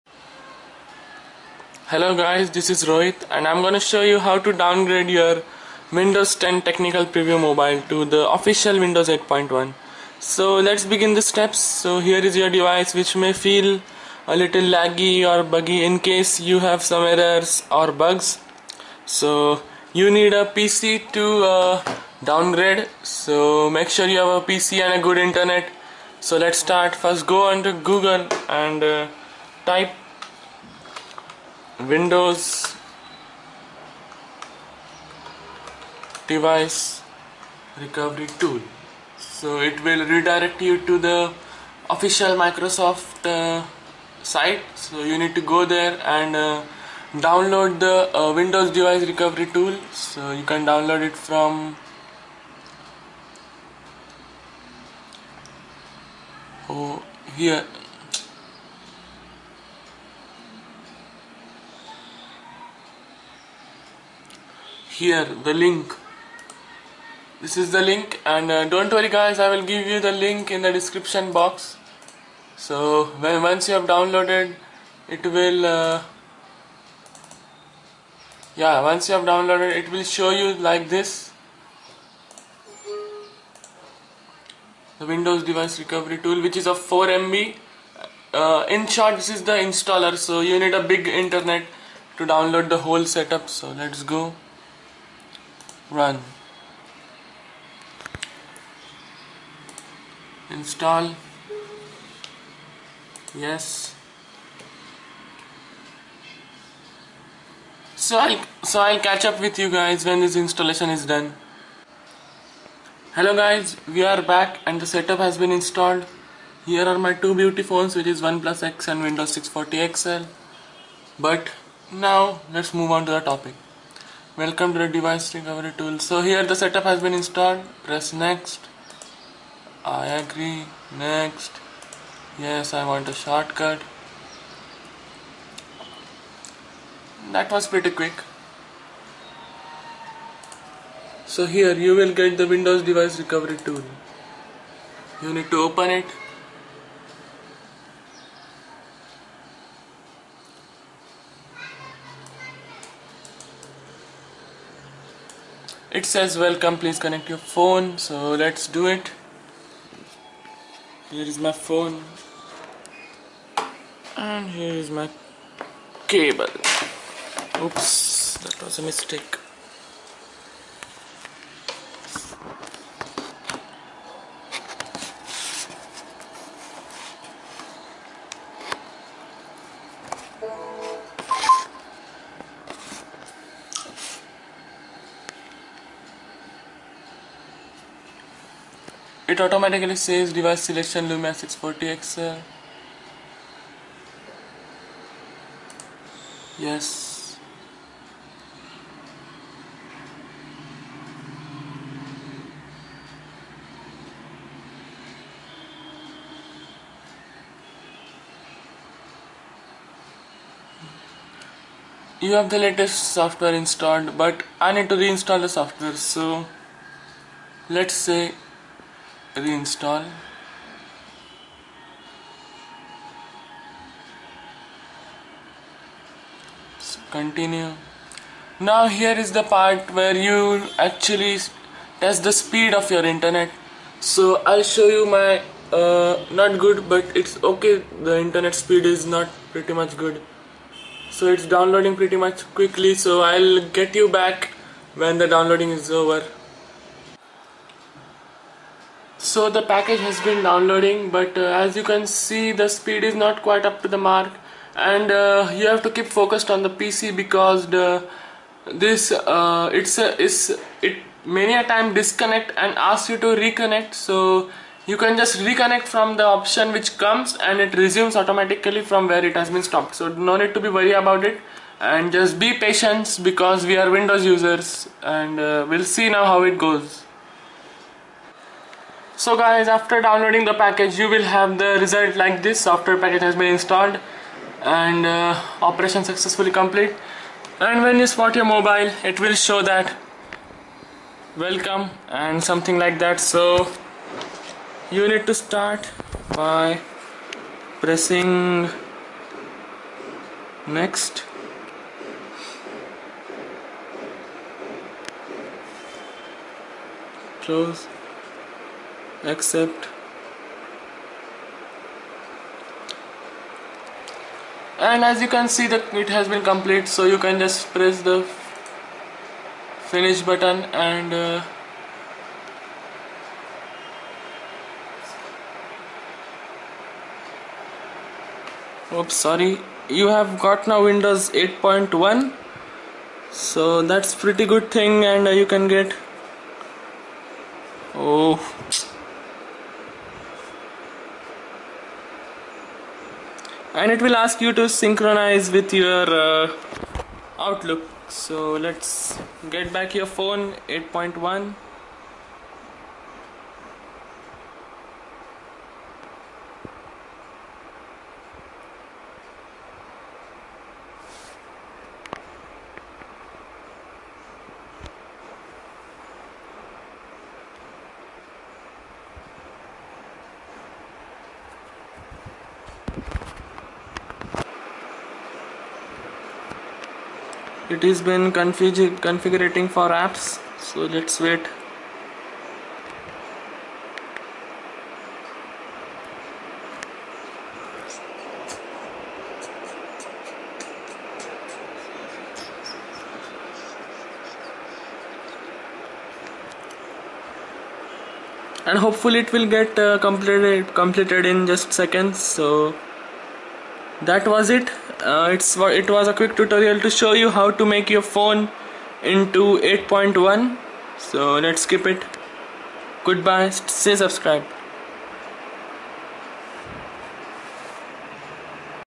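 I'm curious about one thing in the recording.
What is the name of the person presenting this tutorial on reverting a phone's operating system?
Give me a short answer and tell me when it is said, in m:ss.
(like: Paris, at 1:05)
Rohit, at 0:02.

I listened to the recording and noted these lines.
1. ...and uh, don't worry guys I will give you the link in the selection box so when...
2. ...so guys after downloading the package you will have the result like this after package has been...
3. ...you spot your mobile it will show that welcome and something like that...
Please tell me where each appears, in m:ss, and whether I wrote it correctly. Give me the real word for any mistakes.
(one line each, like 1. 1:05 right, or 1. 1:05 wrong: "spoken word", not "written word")
1. 1:08 wrong: "description", not "selection"
2. 4:39 right
3. 4:47 right.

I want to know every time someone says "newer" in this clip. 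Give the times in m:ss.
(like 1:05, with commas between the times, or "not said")
not said.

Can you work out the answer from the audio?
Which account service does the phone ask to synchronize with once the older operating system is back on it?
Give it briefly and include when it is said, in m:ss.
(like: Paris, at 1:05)
Outlook, at 5:47.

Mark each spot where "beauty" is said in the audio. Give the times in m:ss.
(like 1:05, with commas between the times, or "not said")
1:57.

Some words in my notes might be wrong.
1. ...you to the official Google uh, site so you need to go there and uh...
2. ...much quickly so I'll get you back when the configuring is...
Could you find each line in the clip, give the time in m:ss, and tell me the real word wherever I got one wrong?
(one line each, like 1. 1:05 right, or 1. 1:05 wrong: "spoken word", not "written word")
1. 0:40 wrong: "Microsoft", not "Google"
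2. 4:02 wrong: "downloading", not "configuring".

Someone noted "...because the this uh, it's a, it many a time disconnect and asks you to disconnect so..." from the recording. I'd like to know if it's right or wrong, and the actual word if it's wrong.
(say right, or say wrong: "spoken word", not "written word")
wrong: "reconnect", not "disconnect".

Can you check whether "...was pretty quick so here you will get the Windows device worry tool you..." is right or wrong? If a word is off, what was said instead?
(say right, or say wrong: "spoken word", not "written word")
wrong: "recovery", not "worry".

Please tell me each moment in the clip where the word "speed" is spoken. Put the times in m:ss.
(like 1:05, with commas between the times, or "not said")
3:52, 3:58, 4:12.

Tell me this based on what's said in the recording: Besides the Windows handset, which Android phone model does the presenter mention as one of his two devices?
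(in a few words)
OnePlus X.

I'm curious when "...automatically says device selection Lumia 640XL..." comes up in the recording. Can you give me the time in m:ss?
3:09.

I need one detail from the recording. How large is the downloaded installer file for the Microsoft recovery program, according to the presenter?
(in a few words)
4 MB.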